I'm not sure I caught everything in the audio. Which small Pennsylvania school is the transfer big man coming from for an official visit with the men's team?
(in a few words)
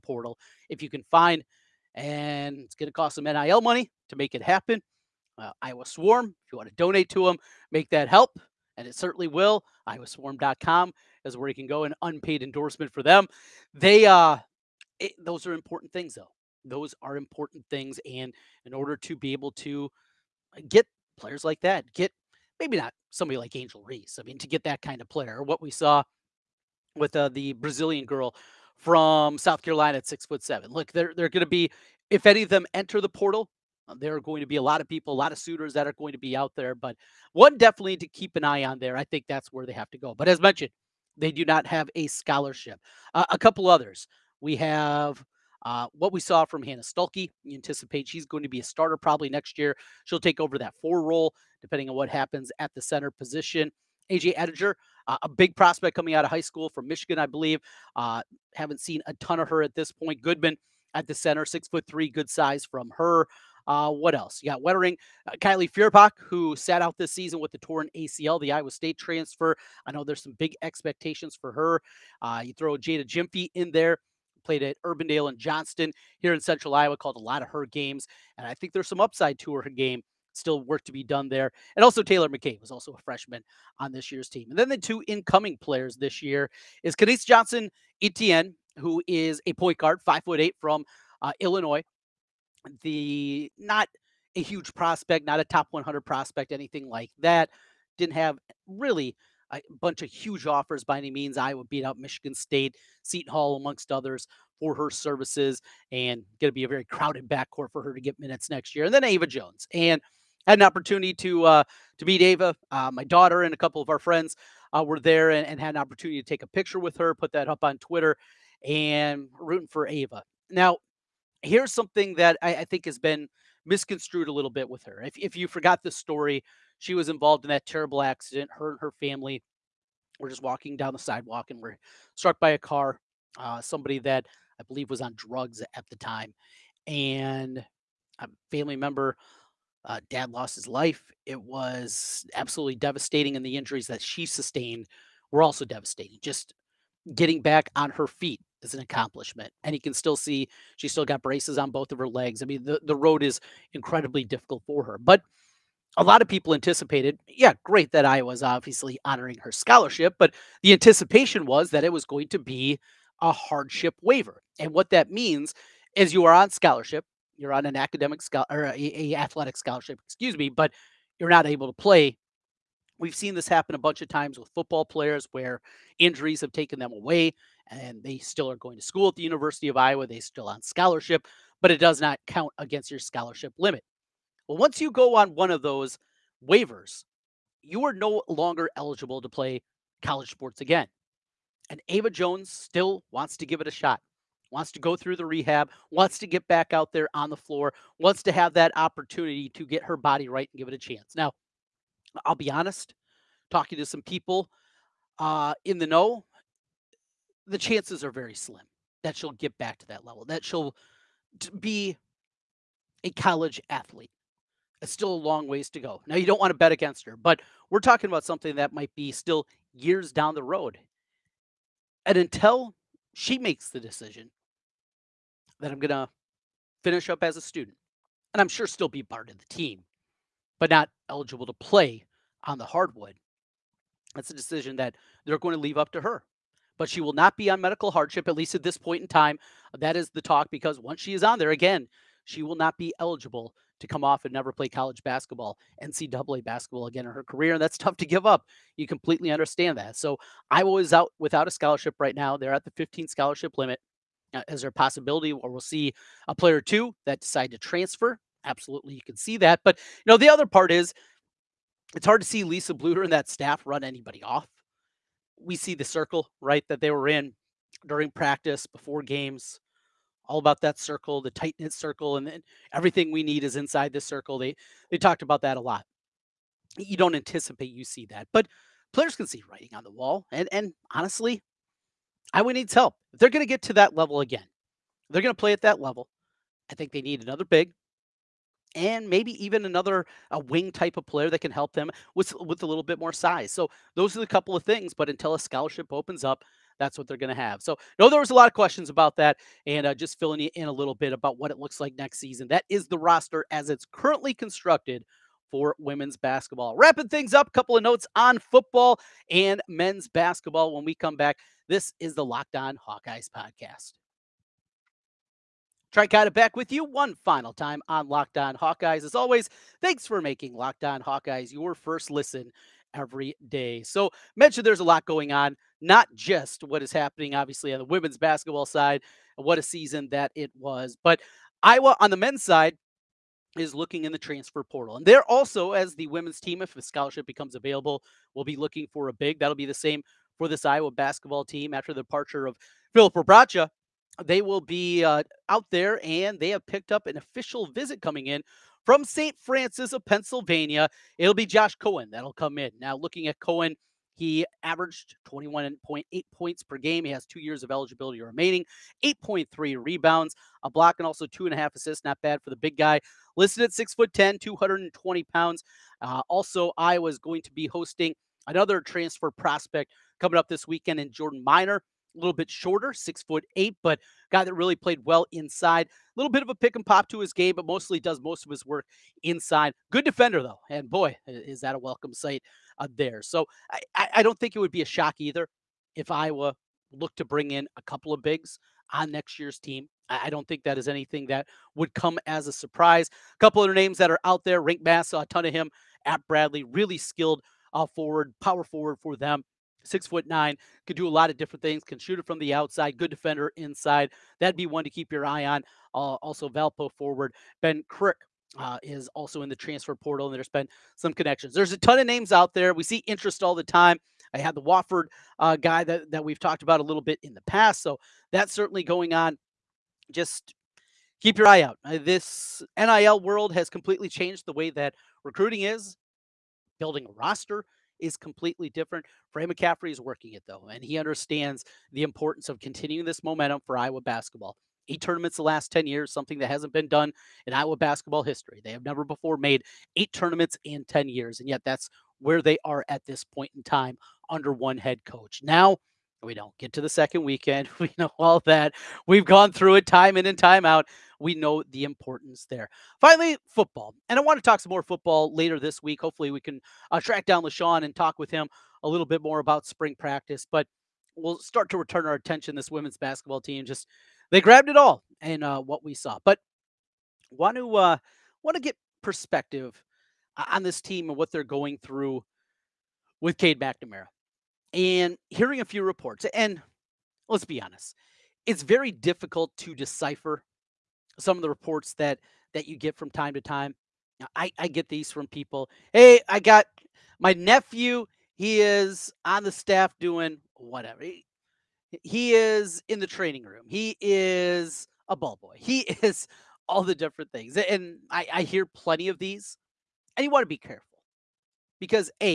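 St. Francis.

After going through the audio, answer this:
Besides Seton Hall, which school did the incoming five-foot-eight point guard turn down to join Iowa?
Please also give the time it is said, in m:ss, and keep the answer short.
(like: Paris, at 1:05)
Michigan State, at 1:41.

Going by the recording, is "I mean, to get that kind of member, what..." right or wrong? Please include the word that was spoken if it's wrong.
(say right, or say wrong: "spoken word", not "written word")
wrong: "player", not "member".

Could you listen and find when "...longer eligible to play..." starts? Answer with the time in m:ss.
3:08.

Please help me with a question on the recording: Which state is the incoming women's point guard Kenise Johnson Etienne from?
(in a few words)
Illinois.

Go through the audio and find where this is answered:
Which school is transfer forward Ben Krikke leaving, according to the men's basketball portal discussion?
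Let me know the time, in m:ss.
6:46.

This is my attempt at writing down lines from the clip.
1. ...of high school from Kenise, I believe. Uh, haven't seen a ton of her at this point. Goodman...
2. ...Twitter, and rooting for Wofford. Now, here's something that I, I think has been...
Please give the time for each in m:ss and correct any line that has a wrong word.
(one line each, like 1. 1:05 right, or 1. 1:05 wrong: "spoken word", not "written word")
1. 0:56 wrong: "Michigan", not "Kenise"
2. 1:57 wrong: "Ava", not "Wofford".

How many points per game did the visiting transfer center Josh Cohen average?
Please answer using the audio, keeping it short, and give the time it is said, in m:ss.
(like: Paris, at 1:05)
21.8, at 5:55.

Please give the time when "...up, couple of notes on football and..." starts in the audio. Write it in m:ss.
5:07.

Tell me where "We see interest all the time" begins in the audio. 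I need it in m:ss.
6:52.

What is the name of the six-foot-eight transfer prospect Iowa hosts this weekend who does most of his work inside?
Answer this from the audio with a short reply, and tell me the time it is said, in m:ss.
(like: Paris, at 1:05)
Jordan Miner, at 6:11.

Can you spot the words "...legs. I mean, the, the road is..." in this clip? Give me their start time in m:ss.
2:32.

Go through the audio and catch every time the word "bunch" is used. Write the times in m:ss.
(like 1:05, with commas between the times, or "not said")
1:39, 2:53.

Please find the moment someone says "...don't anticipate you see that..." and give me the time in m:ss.
4:36.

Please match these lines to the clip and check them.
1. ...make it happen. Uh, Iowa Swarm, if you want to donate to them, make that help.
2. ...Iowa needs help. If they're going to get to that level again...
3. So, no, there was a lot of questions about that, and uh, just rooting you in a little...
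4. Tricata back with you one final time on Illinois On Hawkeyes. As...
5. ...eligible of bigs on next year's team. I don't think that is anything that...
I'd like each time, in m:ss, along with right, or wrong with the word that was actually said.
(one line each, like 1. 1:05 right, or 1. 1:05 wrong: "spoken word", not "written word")
1. 0:04 right
2. 4:42 right
3. 4:57 wrong: "filling", not "rooting"
4. 5:15 wrong: "Locked", not "Illinois"
5. 6:27 wrong: "couple", not "eligible".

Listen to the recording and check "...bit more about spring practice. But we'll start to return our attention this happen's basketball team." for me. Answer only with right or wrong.
wrong.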